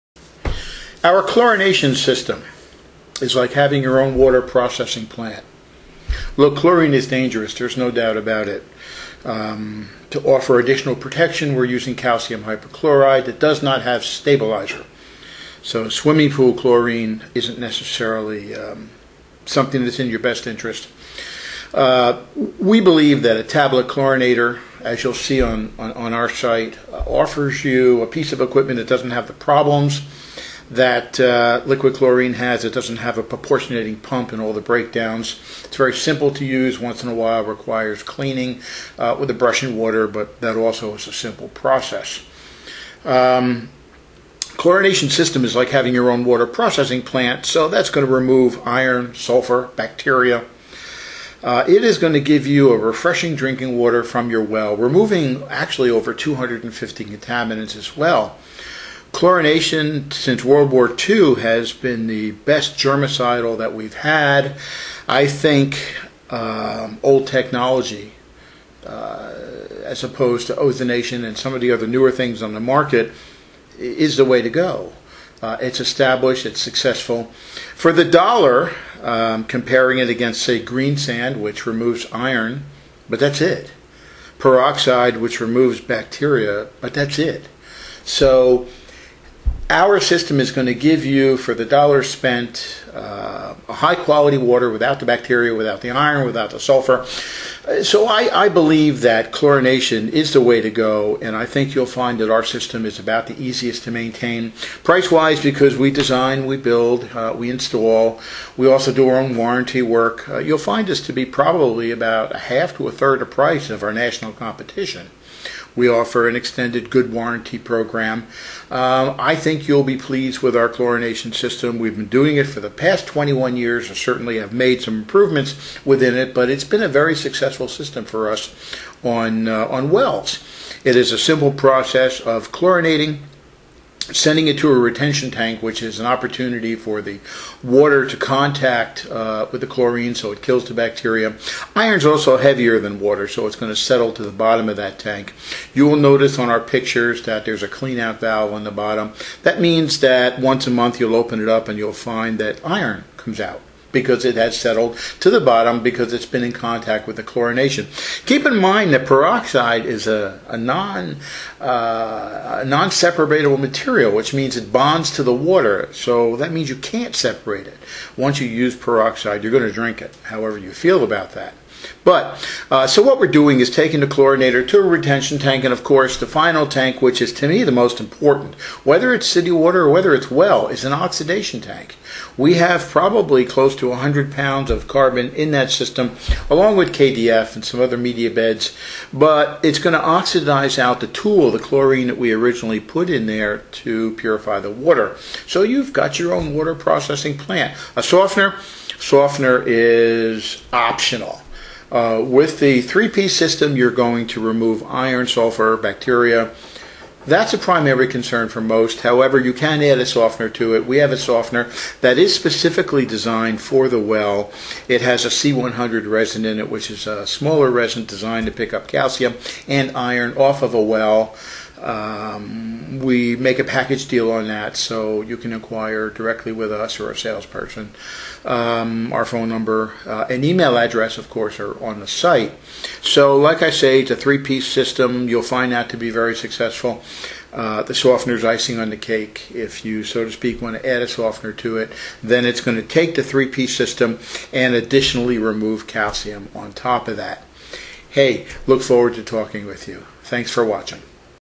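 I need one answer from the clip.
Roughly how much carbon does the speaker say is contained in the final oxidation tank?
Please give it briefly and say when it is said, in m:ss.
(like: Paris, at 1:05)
100 pounds, at 3:03.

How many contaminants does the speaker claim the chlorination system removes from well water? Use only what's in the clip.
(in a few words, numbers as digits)
over 250.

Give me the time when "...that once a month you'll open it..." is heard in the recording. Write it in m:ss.
2:30.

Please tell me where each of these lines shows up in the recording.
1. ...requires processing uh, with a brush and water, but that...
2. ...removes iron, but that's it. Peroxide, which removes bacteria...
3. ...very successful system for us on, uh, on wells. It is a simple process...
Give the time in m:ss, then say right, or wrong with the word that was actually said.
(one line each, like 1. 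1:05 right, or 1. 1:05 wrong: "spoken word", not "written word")
1. 0:37 wrong: "cleaning", not "processing"
2. 1:21 right
3. 2:06 right.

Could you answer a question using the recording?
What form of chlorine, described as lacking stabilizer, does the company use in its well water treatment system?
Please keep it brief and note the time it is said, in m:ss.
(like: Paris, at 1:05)
calcium hypochlorite, at 0:11.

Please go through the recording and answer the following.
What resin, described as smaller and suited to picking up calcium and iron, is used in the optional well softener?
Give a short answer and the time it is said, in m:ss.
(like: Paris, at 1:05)
C100, at 3:35.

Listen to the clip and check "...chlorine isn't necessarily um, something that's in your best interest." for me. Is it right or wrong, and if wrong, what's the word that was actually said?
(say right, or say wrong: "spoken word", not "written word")
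right.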